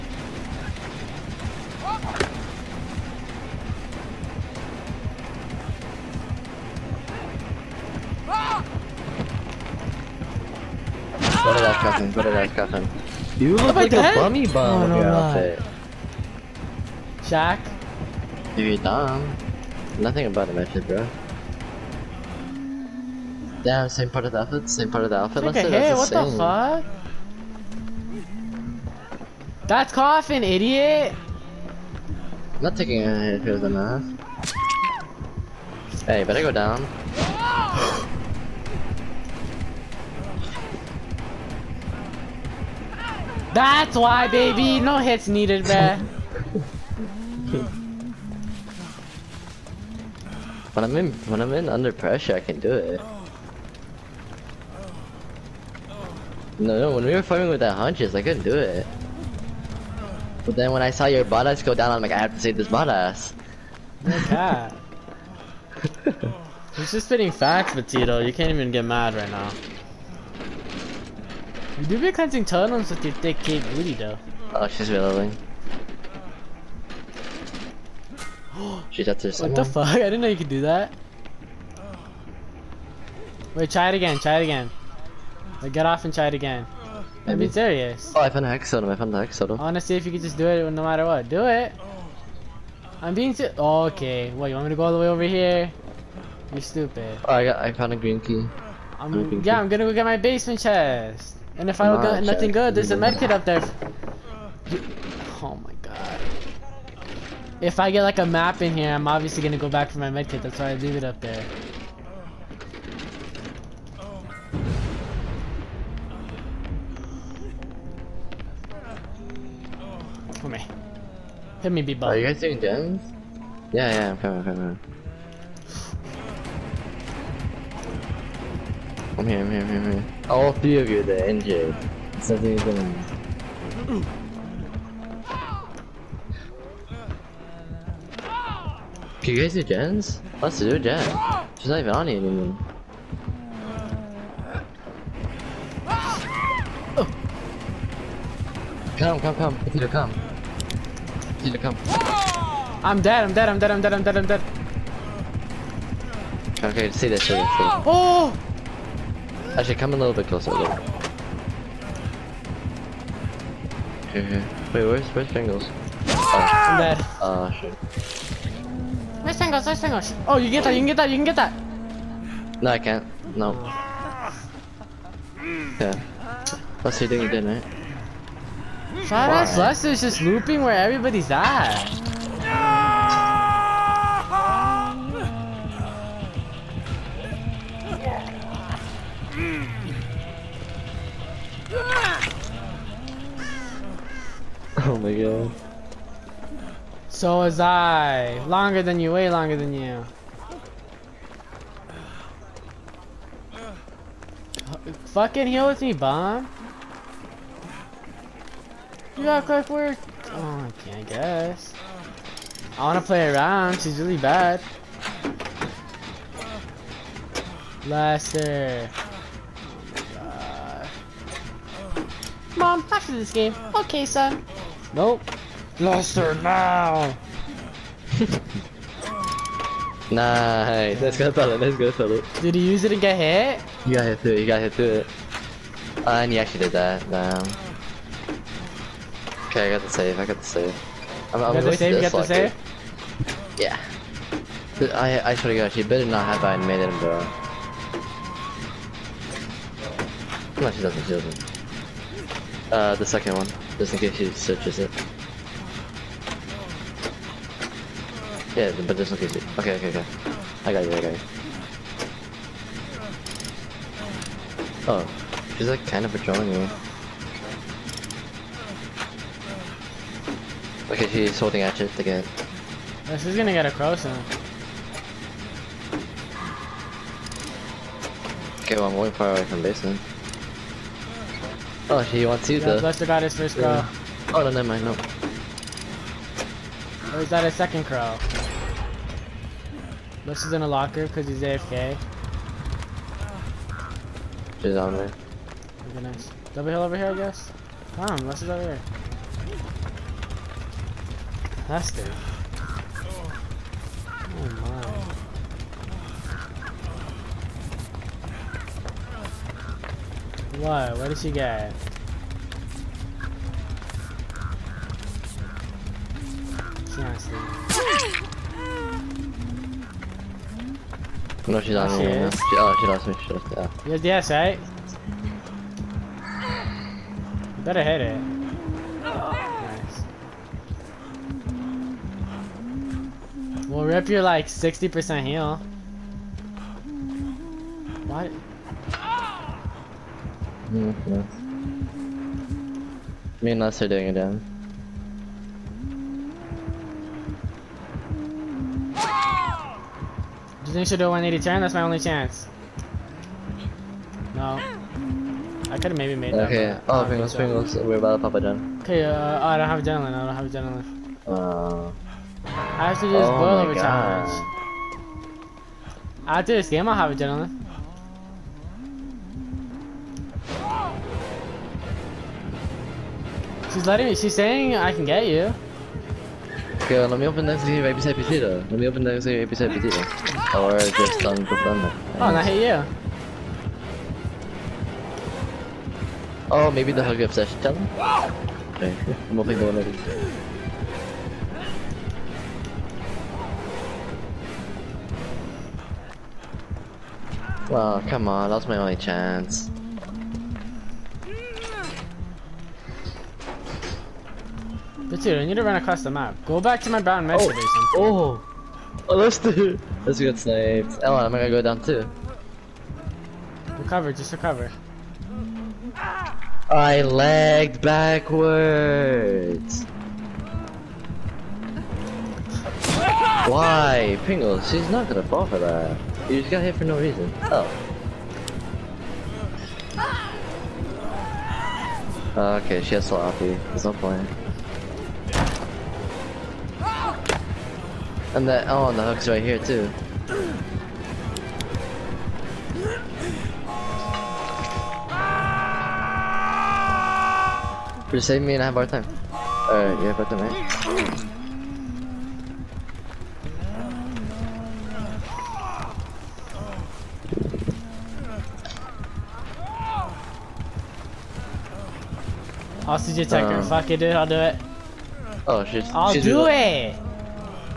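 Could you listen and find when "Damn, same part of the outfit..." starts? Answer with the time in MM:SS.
00:23.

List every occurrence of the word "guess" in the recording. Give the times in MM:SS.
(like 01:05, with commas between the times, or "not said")
03:31, 04:57.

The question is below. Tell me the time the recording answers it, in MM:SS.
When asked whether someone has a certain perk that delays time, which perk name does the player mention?
03:29.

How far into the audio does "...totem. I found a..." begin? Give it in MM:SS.
01:28.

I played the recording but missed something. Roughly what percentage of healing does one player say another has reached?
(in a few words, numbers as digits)
60%.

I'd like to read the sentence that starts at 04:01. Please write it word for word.
I'm, I'm got the save, got the save?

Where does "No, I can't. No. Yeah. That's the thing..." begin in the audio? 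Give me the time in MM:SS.
02:52.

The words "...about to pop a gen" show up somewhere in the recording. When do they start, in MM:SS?
05:57.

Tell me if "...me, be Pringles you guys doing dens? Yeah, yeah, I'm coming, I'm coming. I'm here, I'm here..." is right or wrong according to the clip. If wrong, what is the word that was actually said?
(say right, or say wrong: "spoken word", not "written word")
wrong: "Are", not "Pringles".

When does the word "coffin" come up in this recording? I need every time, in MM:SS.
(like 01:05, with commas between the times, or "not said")
00:11.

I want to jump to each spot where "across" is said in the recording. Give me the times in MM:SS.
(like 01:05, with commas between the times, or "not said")
04:33, 06:45.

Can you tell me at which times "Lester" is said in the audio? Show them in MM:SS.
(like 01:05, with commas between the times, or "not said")
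03:37, 03:45.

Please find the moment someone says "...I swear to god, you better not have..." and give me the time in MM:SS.
04:05.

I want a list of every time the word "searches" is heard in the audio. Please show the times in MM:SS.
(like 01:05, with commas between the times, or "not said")
04:14.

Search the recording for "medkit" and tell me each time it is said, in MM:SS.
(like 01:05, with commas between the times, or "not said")
01:42, 01:50.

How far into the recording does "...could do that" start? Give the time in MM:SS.
01:20.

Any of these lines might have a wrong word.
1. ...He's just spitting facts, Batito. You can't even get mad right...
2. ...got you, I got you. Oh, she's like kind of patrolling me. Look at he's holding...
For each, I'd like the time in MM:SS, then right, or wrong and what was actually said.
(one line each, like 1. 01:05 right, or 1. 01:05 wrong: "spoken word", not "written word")
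1. 01:06 right
2. 04:20 right.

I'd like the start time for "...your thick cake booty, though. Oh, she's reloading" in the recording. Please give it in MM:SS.
01:13.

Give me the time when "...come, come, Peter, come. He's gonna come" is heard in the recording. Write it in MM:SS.
02:29.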